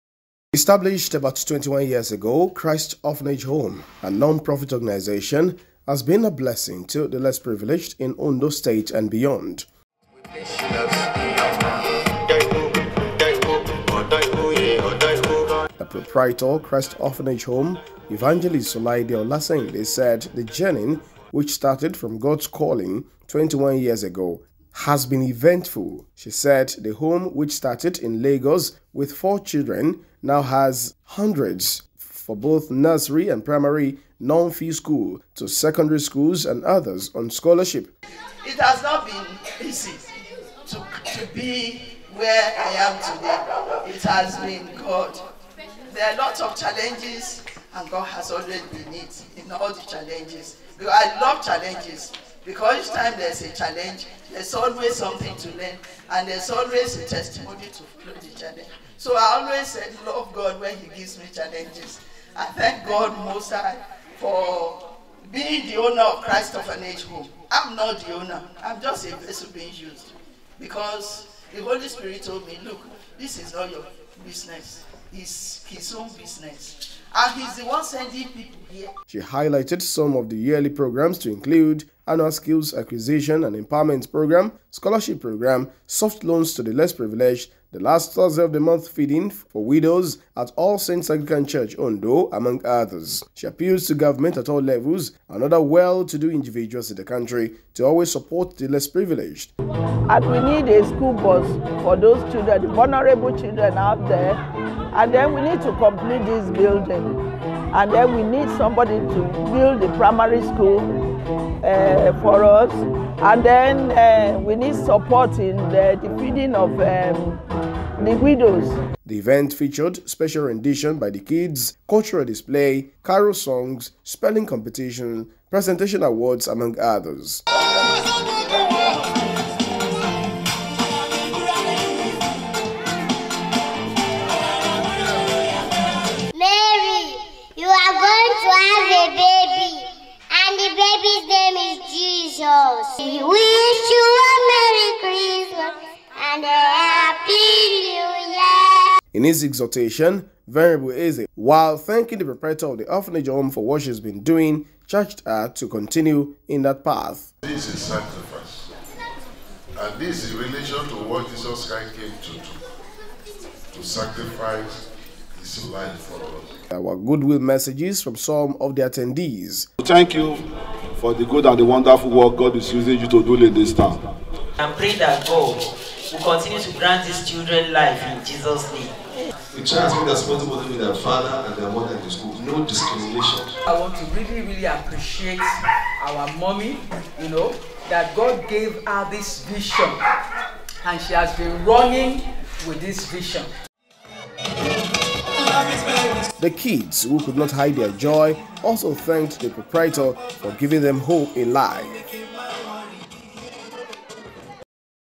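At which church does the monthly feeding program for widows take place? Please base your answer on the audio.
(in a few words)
All Saints Anglican Church.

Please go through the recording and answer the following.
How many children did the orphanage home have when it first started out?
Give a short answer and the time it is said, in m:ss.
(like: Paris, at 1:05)
4, at 0:29.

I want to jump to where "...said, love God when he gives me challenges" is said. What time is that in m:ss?
0:59.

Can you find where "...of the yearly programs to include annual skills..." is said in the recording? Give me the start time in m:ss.
1:20.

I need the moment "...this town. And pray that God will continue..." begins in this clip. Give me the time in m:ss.
2:53.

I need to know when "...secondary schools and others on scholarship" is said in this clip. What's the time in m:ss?
0:35.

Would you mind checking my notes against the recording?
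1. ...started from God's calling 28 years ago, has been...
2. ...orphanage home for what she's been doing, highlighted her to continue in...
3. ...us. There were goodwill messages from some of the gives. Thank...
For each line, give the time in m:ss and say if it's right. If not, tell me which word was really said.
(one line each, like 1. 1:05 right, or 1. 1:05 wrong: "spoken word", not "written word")
1. 0:21 wrong: "21", not "28"
2. 2:32 wrong: "charged", not "highlighted"
3. 2:46 wrong: "attendees", not "gives".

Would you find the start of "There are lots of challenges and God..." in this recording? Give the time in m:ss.
0:45.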